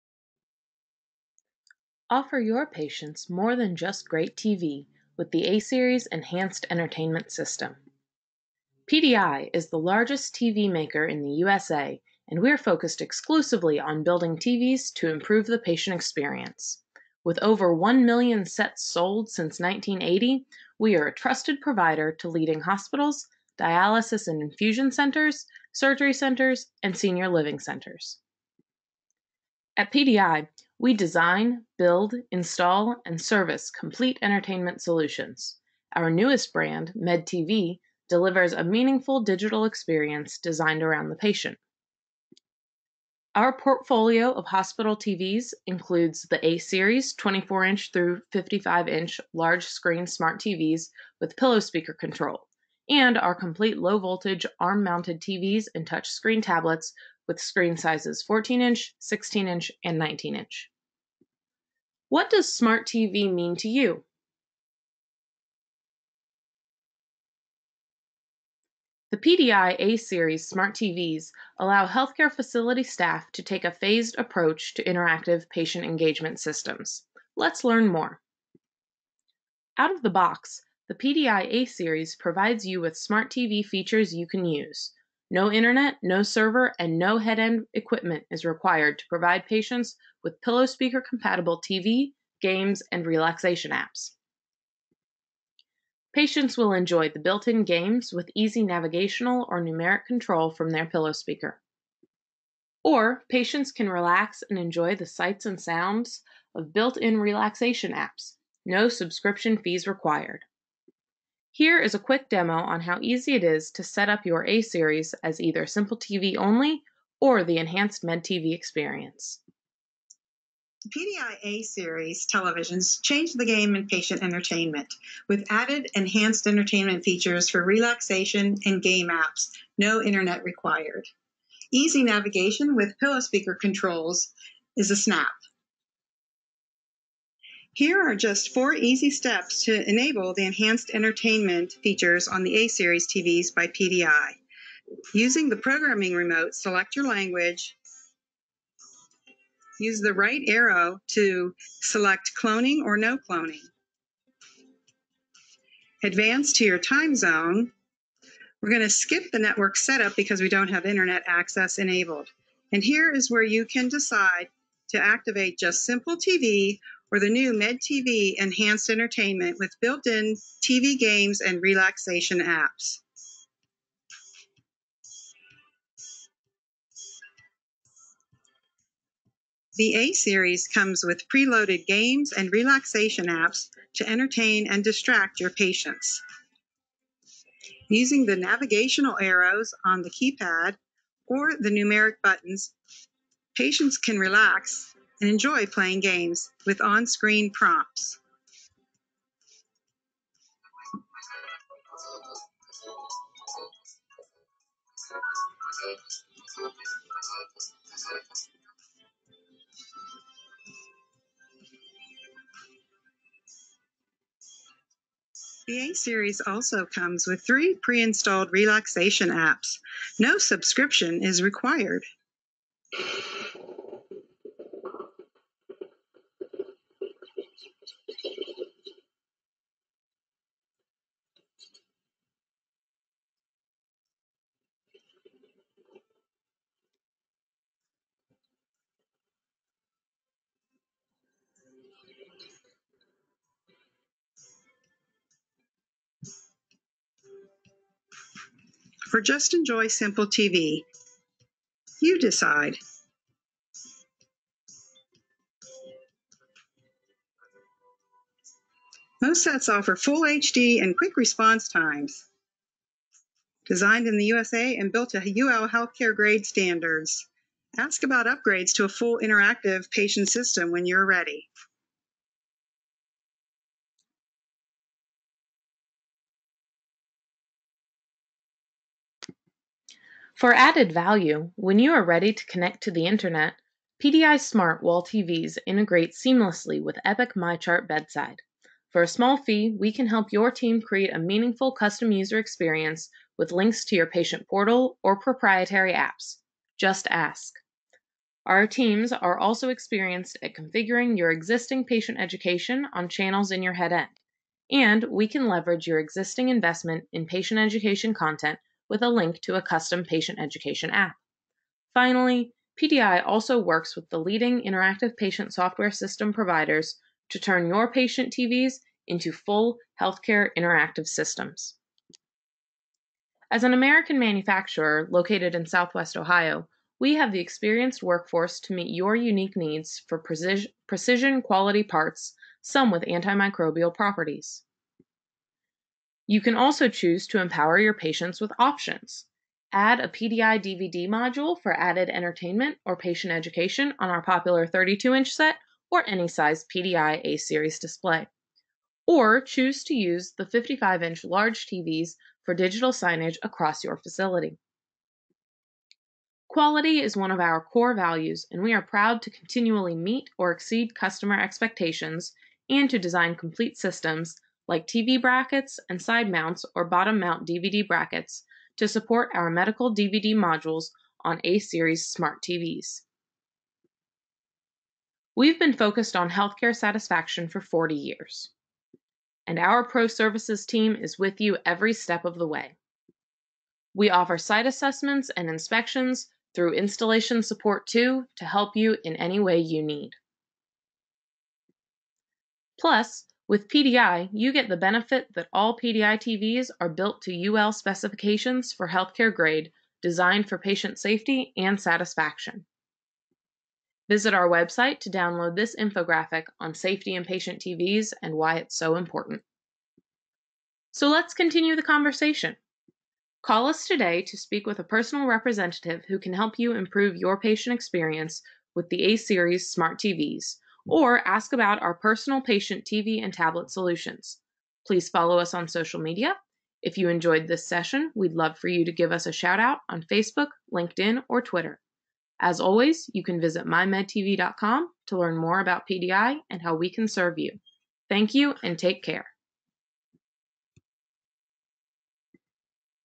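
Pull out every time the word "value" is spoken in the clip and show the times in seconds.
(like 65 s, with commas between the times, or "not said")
280 s, 357 s.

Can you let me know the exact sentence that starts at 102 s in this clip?
Or patients can relax and enjoy the sights and sounds of built in relaxation apps, no subscription fees required.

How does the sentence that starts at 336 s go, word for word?
You can also choose to empower your patients with options.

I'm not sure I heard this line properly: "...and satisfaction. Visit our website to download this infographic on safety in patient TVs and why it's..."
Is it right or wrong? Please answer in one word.
right.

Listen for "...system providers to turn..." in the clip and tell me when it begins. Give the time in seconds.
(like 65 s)
315 s.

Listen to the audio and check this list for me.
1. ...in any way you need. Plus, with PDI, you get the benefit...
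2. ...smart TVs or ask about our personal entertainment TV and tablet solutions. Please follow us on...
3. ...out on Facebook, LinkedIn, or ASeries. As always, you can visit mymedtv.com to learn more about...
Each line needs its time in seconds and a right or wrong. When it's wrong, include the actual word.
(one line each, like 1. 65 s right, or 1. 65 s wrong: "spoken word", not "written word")
1. 389 s right
2. 419 s wrong: "patient", not "entertainment"
3. 429 s wrong: "Twitter", not "ASeries".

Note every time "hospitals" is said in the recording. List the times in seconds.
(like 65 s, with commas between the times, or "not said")
22 s, 44 s.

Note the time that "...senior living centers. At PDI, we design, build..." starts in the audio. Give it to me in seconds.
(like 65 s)
26 s.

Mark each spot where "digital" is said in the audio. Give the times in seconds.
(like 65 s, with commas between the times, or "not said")
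39 s, 352 s.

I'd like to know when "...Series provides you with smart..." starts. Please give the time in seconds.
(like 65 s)
81 s.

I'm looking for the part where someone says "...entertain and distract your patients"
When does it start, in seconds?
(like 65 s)
184 s.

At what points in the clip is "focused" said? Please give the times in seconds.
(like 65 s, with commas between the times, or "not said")
12 s, 375 s.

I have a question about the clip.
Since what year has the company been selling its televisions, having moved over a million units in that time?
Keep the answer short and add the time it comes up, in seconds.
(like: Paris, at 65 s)
1980, at 19 s.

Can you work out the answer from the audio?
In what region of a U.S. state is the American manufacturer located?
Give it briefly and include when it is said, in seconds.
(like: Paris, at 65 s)
Southwest Ohio, at 325 s.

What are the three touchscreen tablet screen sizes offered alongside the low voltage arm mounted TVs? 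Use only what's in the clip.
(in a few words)
14, 16, and 19 inch.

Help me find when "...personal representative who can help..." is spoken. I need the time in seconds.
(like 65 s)
414 s.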